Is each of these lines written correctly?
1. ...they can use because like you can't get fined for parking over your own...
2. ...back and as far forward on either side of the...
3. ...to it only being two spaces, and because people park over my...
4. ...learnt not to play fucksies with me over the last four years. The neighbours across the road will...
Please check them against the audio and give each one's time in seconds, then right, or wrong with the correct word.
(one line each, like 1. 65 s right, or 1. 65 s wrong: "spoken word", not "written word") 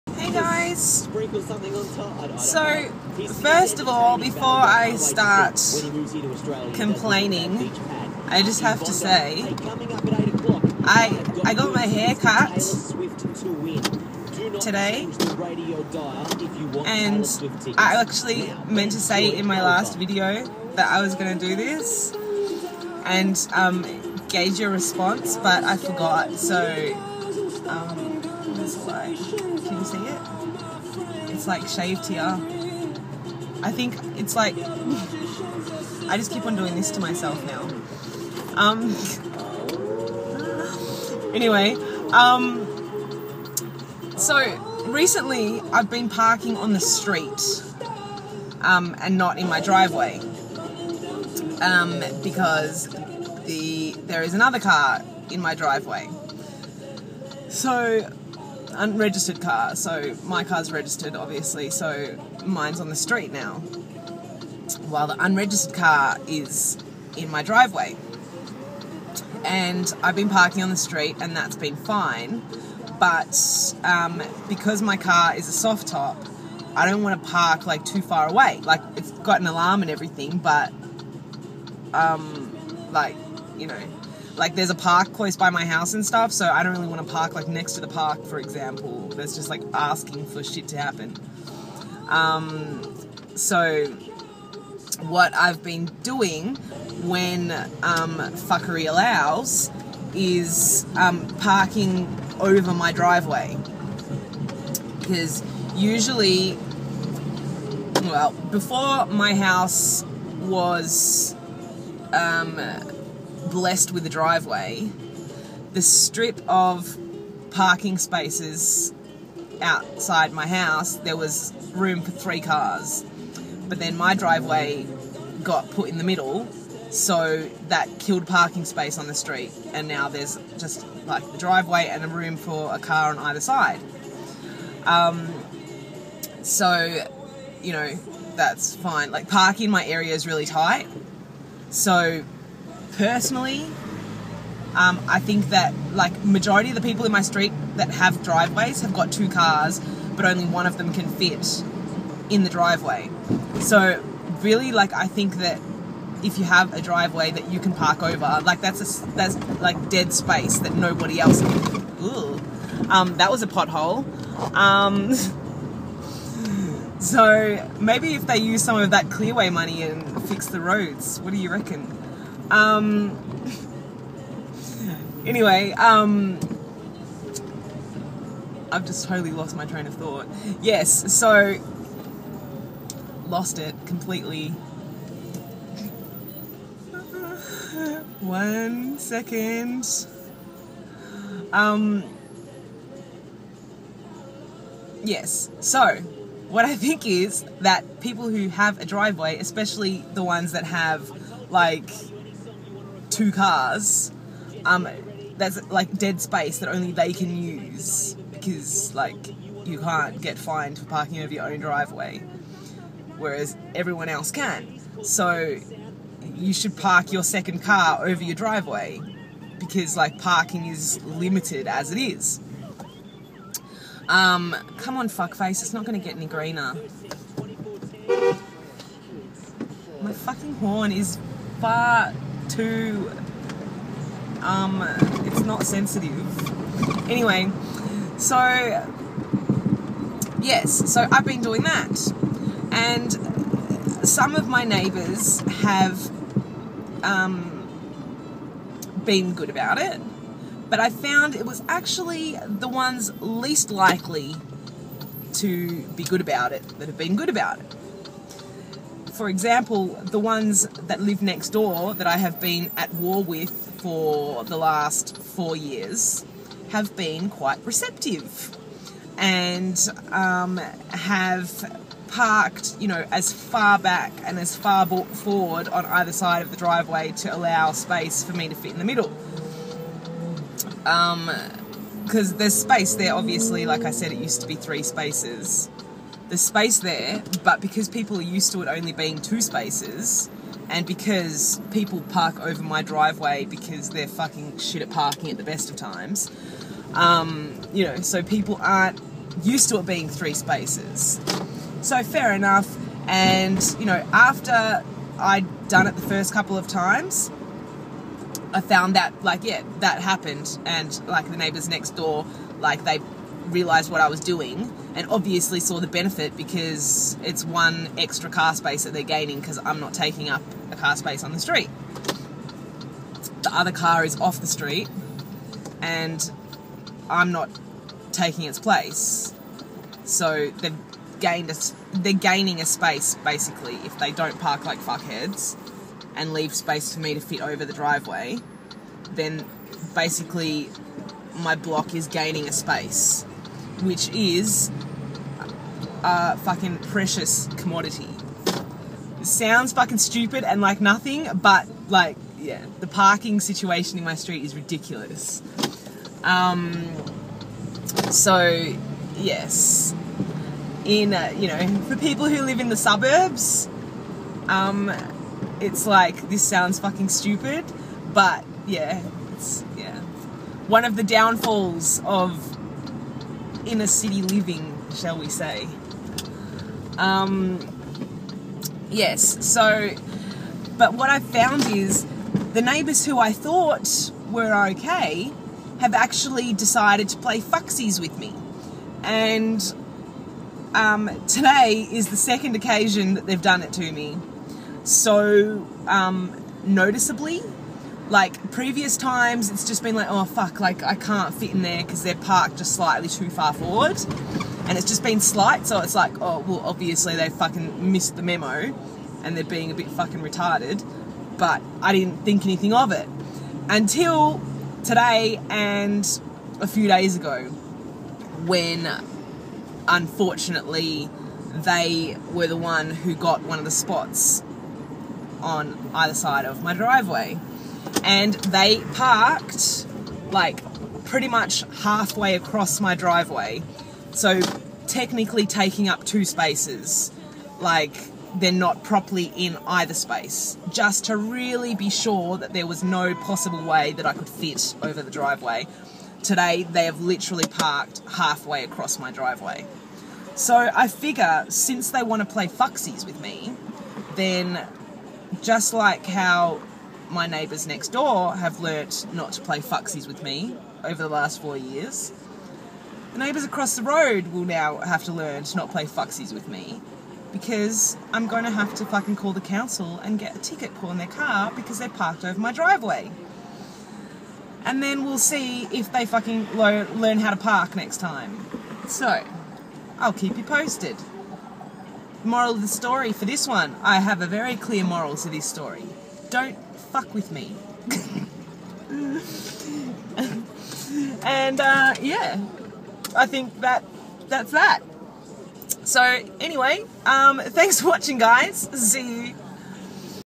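1. 206 s right
2. 273 s right
3. 288 s right
4. 458 s right.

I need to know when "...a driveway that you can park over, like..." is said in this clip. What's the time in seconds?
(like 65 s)
156 s.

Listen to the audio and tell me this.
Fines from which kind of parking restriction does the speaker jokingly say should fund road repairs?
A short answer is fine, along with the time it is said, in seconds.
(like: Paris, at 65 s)
Clearway, at 169 s.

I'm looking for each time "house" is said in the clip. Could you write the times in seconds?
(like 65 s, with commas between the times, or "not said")
85 s, 109 s, 120 s.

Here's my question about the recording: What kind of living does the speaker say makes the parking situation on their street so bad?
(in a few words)
Inner city living.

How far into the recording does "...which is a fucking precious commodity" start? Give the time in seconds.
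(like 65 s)
343 s.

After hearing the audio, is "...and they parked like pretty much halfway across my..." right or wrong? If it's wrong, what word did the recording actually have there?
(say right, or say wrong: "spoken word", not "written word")
right.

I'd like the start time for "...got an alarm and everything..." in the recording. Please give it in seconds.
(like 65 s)
79 s.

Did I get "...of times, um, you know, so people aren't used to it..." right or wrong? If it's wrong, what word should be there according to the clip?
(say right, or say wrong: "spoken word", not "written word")
right.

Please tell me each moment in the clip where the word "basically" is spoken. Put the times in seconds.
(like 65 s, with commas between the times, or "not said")
333 s, 339 s.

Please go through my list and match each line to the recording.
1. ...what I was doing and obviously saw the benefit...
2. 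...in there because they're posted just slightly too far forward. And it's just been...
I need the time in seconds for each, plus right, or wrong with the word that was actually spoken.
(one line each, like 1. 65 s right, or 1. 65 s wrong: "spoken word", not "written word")
1. 313 s right
2. 401 s wrong: "parked", not "posted".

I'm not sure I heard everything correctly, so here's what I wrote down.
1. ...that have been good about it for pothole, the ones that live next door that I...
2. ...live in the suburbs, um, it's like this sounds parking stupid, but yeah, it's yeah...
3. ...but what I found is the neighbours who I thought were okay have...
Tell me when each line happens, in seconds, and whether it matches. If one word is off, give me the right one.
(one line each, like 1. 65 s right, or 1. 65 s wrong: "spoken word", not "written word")
1. 256 s wrong: "example", not "pothole"
2. 362 s wrong: "fucking", not "parking"
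3. 380 s right.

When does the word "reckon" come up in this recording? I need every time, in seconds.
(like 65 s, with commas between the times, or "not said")
171 s.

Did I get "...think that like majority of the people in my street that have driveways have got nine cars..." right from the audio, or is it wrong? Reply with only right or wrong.
wrong.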